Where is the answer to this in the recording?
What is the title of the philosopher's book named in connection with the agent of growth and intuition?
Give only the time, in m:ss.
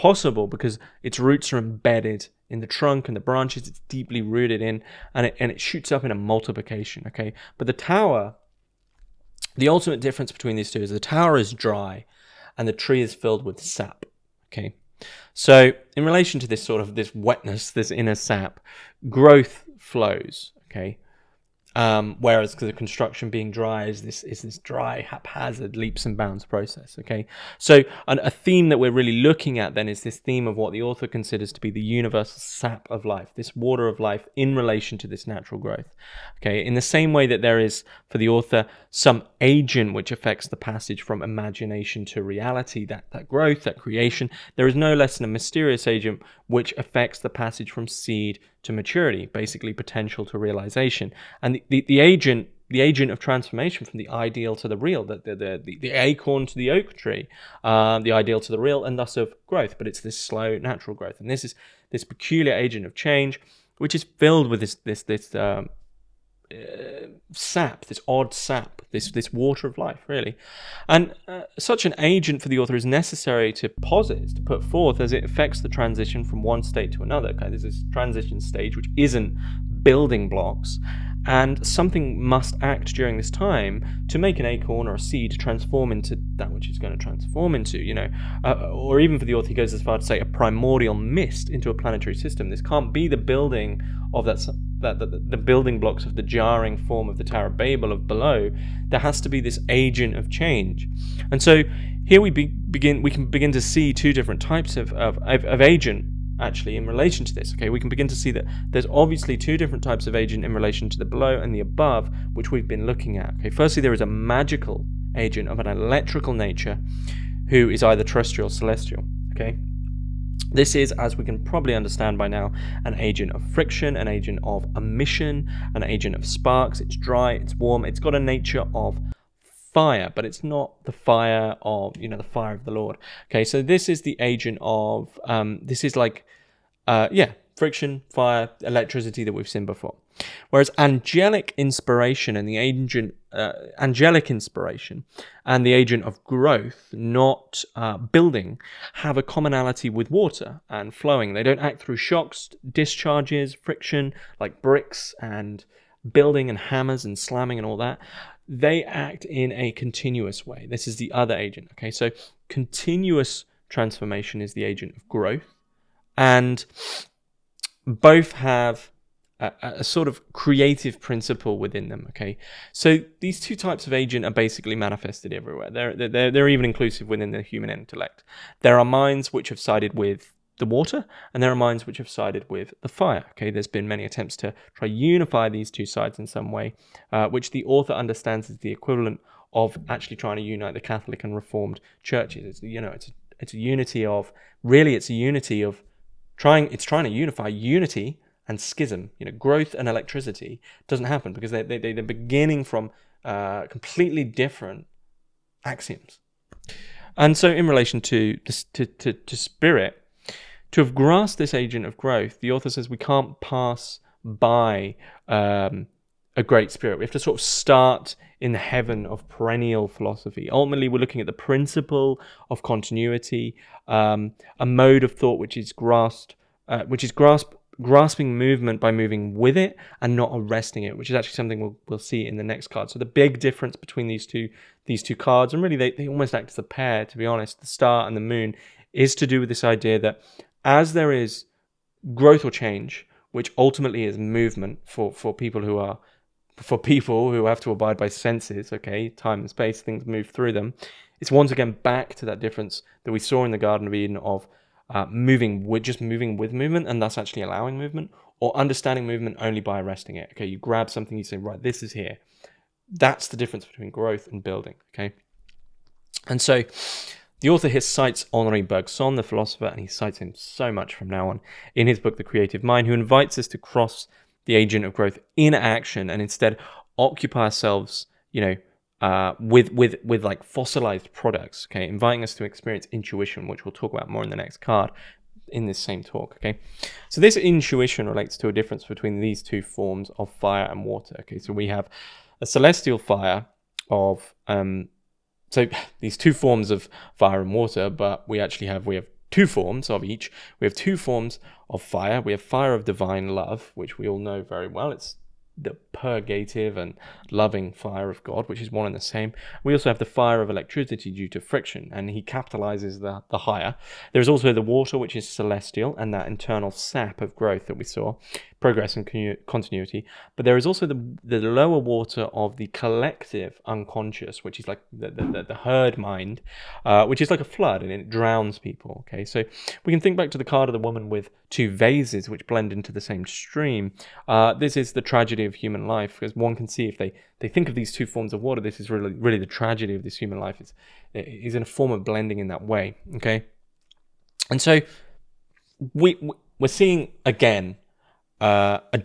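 4:32.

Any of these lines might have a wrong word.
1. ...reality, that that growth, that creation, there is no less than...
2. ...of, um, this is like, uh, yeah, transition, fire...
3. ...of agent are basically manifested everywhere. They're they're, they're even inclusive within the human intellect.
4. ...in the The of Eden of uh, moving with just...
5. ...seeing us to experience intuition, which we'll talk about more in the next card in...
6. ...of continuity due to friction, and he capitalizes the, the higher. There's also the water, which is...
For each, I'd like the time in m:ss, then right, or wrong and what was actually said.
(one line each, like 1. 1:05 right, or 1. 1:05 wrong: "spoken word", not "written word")
1. 0:42 right
2. 2:14 wrong: "friction", not "transition"
3. 2:53 right
4. 4:13 wrong: "Garden", not "The"
5. 4:41 wrong: "inviting", not "seeing"
6. 5:10 wrong: "electricity", not "continuity".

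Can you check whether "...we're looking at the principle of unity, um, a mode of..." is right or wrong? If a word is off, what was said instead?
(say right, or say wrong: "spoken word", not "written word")
wrong: "continuity", not "unity".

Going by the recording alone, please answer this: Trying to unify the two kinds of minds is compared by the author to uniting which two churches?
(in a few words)
Catholic and Reformed.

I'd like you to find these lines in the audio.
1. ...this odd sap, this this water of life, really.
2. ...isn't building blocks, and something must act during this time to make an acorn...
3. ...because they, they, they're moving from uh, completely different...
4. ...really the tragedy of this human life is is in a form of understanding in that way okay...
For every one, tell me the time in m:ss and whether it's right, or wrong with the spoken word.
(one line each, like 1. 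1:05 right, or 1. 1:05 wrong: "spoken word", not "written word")
1. 1:07 right
2. 1:18 right
3. 3:21 wrong: "beginning", not "moving"
4. 5:39 wrong: "blending", not "understanding".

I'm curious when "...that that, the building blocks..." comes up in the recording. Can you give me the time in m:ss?
1:34.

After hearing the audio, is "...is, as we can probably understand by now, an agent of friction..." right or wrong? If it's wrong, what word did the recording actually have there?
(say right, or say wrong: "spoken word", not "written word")
right.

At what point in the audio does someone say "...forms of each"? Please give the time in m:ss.
4:59.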